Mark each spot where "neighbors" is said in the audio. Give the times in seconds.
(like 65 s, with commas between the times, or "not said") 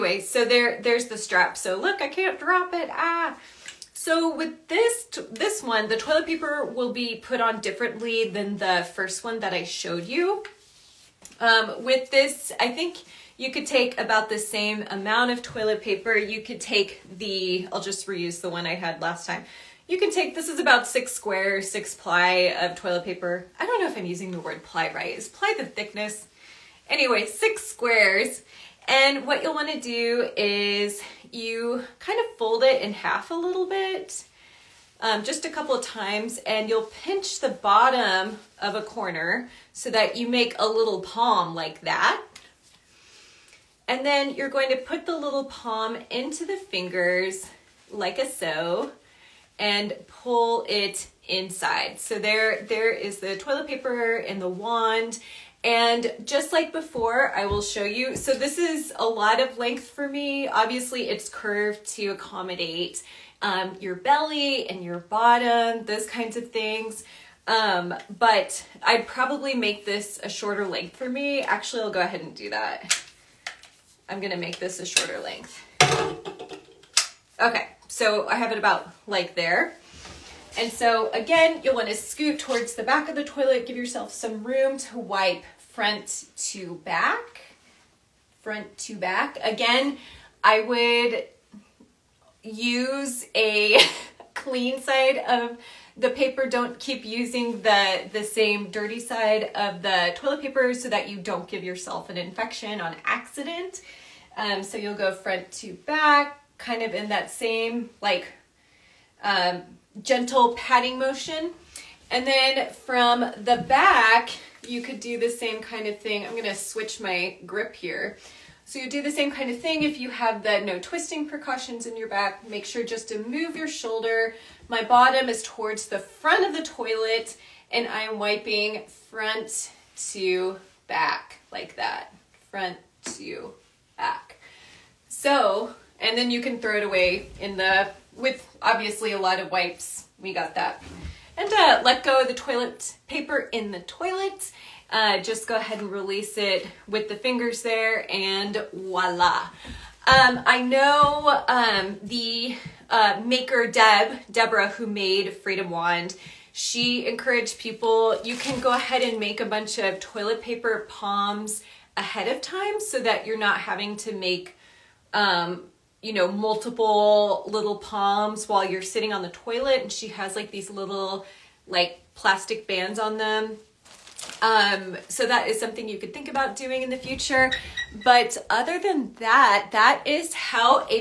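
not said.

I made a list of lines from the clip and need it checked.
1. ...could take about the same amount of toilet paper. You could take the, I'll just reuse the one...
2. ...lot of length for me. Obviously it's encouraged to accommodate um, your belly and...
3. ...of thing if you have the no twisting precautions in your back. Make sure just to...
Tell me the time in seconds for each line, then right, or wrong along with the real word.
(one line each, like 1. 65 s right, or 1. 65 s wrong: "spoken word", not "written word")
1. 13 s right
2. 59 s wrong: "curved", not "encouraged"
3. 119 s right.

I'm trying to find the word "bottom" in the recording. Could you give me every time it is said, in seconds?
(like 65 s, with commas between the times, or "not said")
37 s, 64 s, 124 s.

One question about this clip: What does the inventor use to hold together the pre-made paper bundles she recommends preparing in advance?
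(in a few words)
Plastic bands.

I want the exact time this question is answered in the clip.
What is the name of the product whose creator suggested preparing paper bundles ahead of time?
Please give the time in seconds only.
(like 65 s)
155 s.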